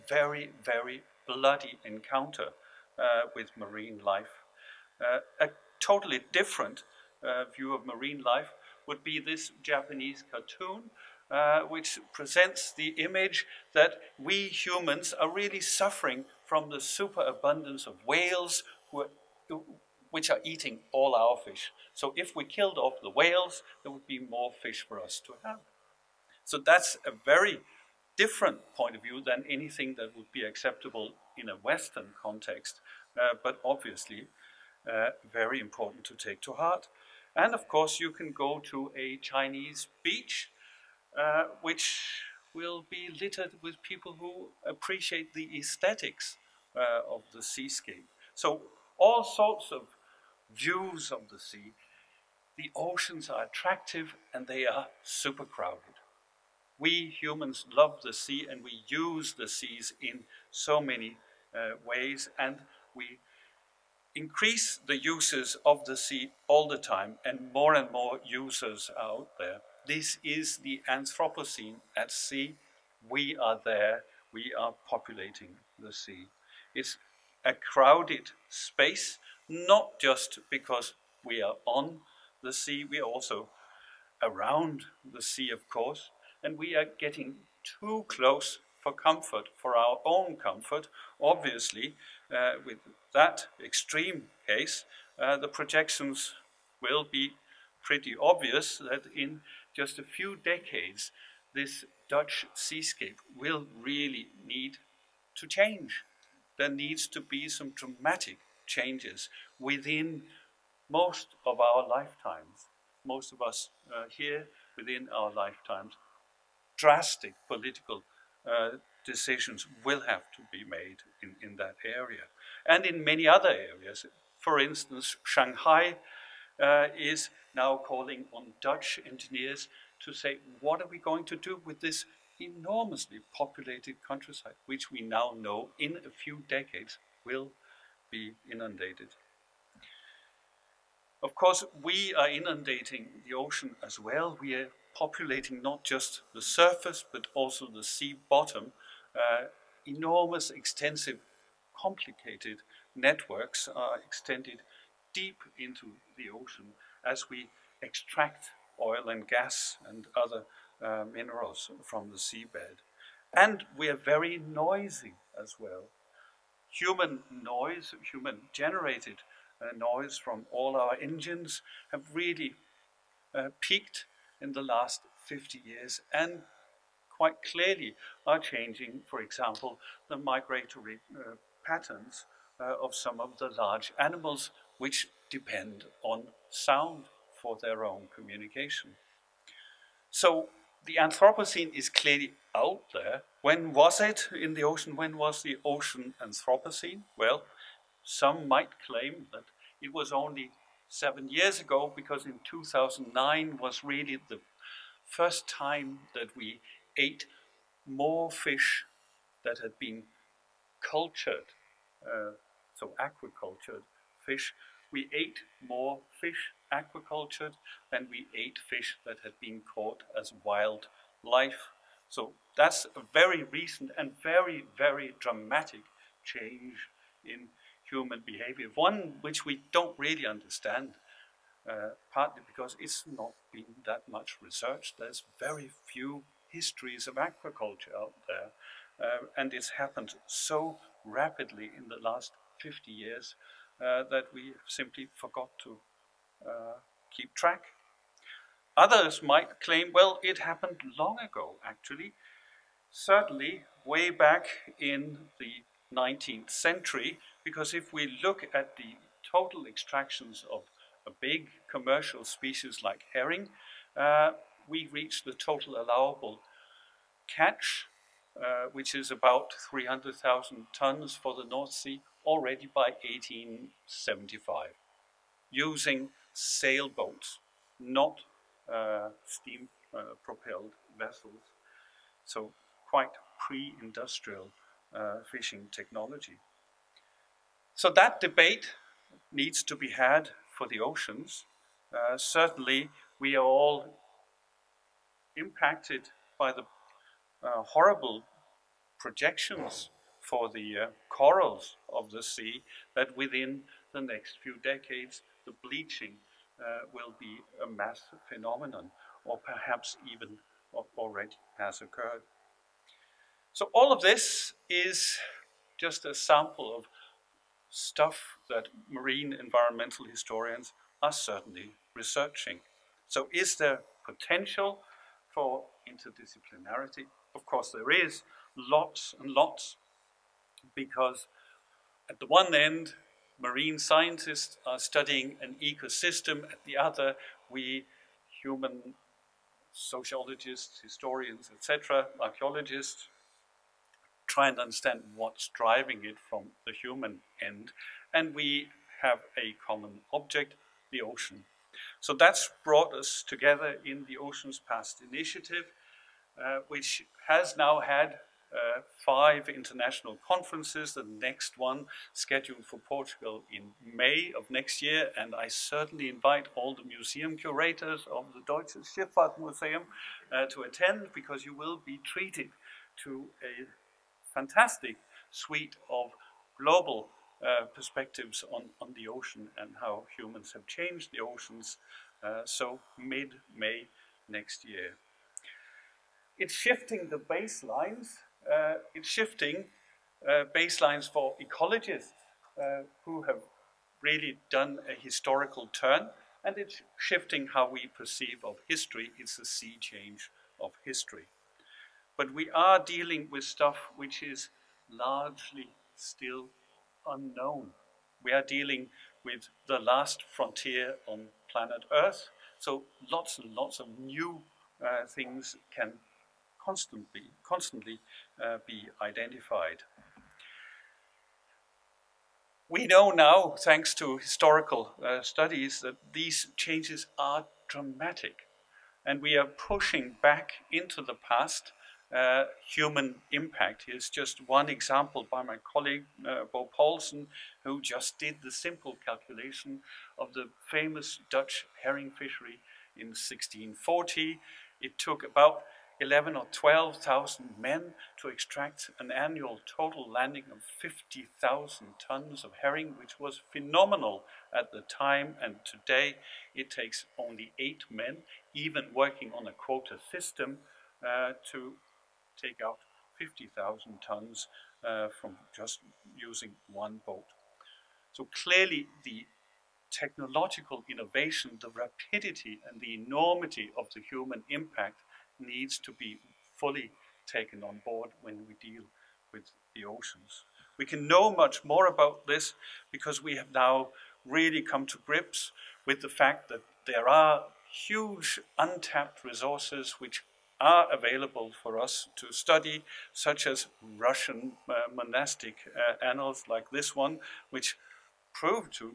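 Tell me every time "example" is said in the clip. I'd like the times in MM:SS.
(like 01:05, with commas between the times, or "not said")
02:59, 07:14.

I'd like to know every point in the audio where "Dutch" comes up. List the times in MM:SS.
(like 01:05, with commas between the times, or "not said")
01:42, 02:08, 07:21.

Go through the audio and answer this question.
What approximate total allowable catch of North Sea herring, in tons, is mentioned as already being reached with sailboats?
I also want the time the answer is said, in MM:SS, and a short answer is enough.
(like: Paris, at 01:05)
300,000 tons, at 04:29.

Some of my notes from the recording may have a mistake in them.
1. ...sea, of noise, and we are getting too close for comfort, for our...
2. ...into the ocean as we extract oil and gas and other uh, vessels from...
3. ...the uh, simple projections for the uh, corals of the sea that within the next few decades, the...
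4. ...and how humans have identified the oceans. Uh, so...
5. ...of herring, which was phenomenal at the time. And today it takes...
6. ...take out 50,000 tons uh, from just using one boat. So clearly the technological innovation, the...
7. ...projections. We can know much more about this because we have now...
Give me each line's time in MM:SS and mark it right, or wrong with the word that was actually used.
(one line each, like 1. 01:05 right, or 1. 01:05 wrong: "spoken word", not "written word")
1. 01:25 wrong: "course", not "noise"
2. 02:35 wrong: "minerals", not "vessels"
3. 04:56 wrong: "horrible", not "simple"
4. 06:19 wrong: "changed", not "identified"
5. 07:32 right
6. 07:42 right
7. 07:59 wrong: "oceans", not "projections".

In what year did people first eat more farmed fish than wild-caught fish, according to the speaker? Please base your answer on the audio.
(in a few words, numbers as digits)
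2009.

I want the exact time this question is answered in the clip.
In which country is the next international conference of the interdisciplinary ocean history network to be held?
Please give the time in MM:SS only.
06:02.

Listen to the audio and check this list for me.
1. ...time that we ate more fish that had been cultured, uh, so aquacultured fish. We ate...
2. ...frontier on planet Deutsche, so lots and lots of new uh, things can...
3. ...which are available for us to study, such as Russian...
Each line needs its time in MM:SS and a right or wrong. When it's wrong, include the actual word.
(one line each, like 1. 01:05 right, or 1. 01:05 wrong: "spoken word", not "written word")
1. 03:25 right
2. 06:50 wrong: "Earth", not "Deutsche"
3. 08:09 right.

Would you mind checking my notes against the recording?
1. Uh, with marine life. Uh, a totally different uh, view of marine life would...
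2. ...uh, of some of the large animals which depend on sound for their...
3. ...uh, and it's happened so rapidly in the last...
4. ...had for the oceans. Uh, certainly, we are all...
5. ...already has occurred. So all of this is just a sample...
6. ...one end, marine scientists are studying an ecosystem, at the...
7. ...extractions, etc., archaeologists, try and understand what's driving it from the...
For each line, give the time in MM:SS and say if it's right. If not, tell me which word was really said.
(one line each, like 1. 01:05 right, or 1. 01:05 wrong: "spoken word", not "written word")
1. 00:03 right
2. 03:02 right
3. 03:59 right
4. 04:49 right
5. 05:10 right
6. 05:32 right
7. 05:40 wrong: "historians", not "extractions".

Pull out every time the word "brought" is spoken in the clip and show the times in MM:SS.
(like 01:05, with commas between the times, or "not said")
05:52.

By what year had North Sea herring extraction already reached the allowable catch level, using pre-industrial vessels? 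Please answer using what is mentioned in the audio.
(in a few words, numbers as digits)
1875.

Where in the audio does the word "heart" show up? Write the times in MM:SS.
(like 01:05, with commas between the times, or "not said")
00:36.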